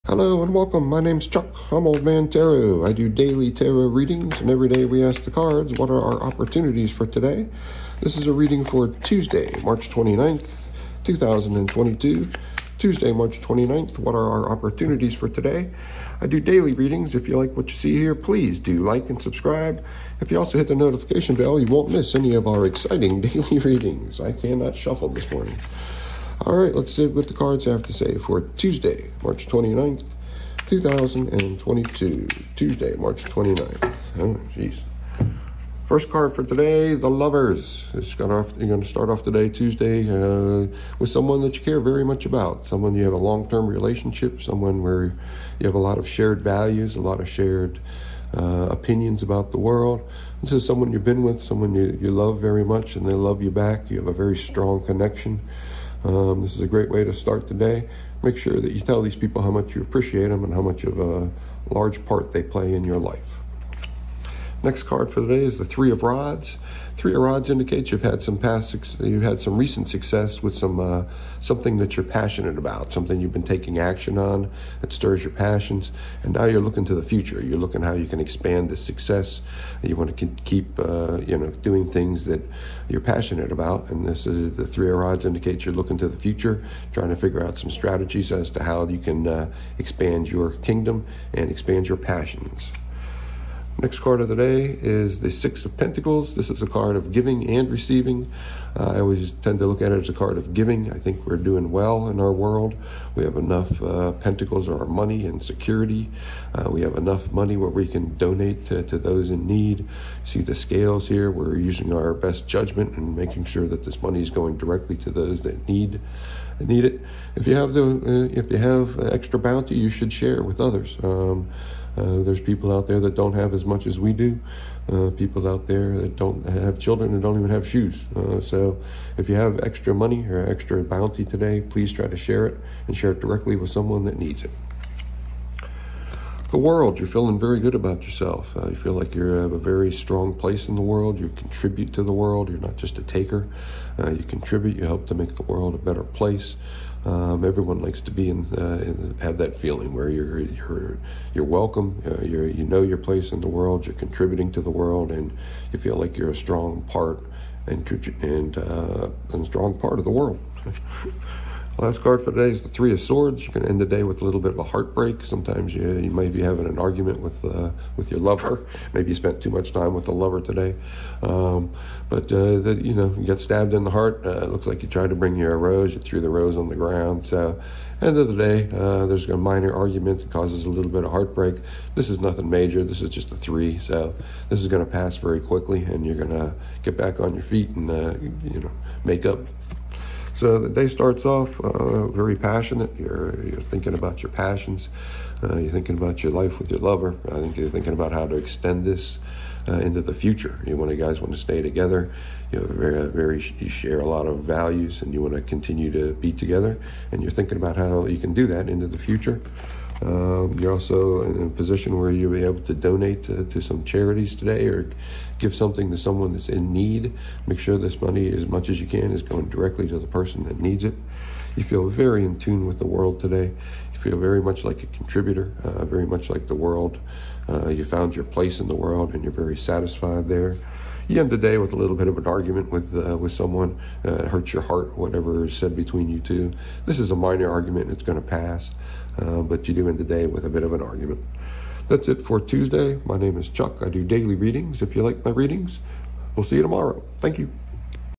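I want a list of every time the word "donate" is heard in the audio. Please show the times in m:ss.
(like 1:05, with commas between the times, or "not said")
1:48, 3:32.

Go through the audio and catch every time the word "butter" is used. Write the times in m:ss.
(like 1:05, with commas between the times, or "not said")
not said.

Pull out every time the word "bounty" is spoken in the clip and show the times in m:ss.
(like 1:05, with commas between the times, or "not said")
1:59, 2:10.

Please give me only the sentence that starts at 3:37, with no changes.
Make sure this money, as much as you can, is going directly to the person that needs it.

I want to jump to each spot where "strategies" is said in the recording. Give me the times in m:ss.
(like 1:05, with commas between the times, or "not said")
1:27.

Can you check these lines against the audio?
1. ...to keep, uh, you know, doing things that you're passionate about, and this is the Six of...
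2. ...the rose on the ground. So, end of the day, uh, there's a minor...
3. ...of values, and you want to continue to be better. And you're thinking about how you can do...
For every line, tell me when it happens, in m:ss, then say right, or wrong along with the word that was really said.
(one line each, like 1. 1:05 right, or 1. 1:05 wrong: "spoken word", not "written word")
1. 1:20 wrong: "Three", not "Six"
2. 2:56 right
3. 3:24 wrong: "together", not "better".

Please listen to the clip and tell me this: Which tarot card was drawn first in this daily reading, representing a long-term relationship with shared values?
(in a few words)
The Lovers.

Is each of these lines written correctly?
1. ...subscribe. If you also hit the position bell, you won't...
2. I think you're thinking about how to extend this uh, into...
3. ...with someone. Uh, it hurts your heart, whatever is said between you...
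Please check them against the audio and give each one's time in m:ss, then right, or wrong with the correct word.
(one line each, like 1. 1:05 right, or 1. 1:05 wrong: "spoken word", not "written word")
1. 0:19 wrong: "notification", not "position"
2. 3:17 right
3. 3:53 right.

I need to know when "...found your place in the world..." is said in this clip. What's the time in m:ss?
3:47.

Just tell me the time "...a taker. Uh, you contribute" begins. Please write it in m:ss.
2:22.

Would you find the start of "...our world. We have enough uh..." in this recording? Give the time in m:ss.
1:42.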